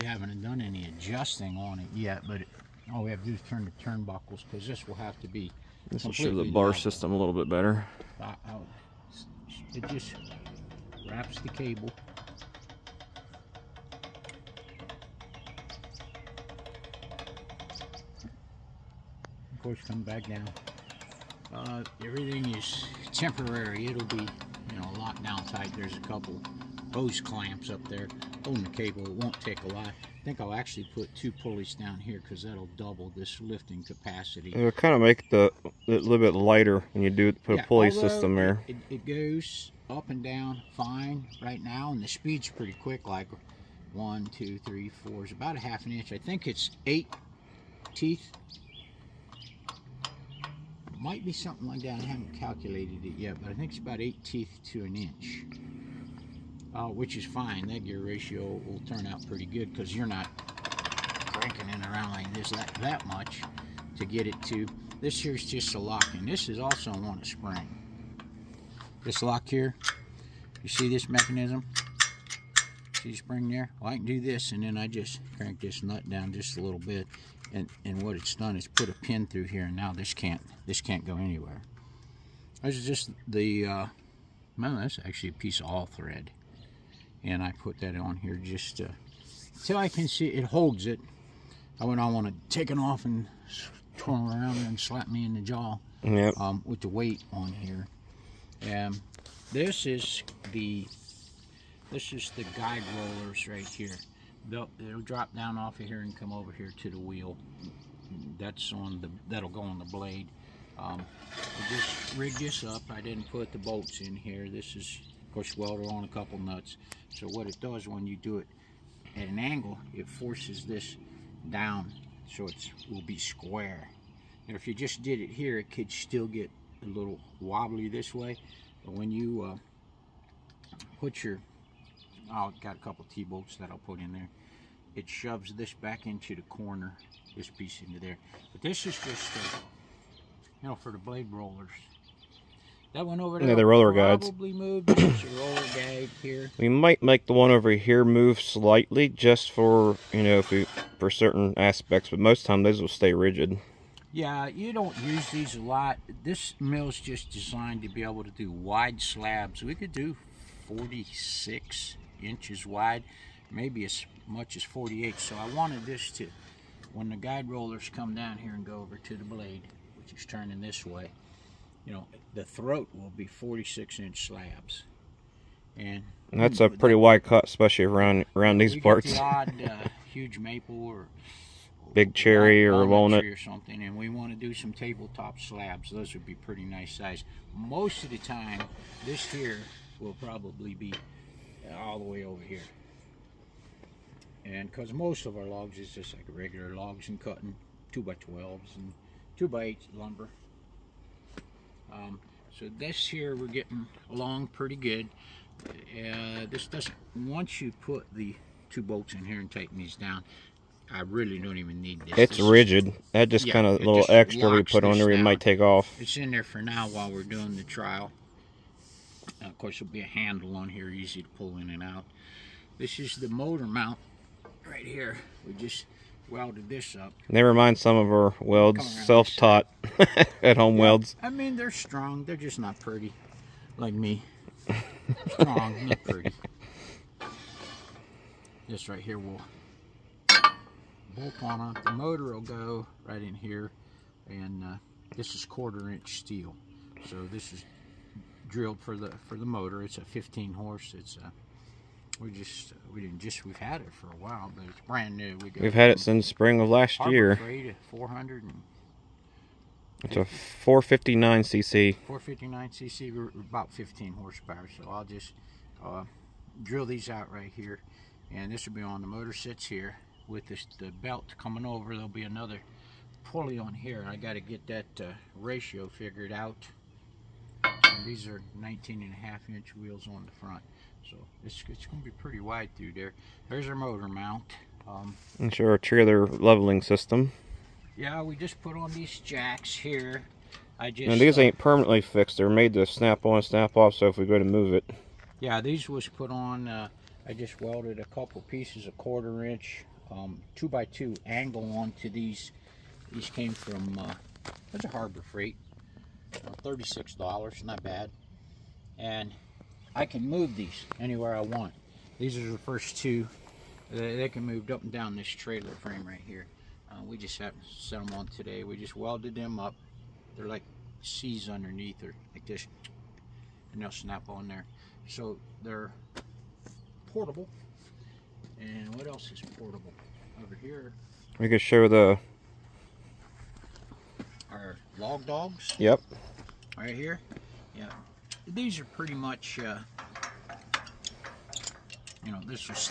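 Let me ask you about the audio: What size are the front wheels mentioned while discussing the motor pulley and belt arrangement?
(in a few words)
19 and a half inch.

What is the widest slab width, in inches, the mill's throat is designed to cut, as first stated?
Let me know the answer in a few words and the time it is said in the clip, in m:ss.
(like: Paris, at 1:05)
46 inches, at 2:40.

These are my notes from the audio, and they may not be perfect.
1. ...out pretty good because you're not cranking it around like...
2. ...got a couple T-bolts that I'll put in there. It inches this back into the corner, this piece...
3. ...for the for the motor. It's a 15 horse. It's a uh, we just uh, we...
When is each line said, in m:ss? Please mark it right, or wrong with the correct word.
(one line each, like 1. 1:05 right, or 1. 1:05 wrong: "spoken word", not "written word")
1. 0:59 right
2. 2:12 wrong: "shoves", not "inches"
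3. 4:08 right.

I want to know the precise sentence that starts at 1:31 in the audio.
I would not want to take it off and turn around and slap me in the jaw yep.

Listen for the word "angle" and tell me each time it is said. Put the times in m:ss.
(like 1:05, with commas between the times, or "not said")
1:59, 5:01.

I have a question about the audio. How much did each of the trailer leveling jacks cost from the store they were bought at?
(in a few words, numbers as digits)
$36.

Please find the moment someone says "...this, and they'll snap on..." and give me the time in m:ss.
5:22.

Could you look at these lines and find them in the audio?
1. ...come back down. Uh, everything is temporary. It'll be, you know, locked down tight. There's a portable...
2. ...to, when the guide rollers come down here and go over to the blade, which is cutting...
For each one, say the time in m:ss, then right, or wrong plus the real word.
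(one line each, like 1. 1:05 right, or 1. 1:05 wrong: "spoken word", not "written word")
1. 0:19 wrong: "couple", not "portable"
2. 2:46 wrong: "turning", not "cutting".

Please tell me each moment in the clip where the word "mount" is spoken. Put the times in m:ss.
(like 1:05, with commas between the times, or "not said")
3:43, 4:44.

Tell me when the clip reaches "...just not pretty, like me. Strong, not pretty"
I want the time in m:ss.
3:52.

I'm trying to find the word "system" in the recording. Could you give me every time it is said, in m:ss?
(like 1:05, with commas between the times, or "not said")
0:06, 0:37, 4:46.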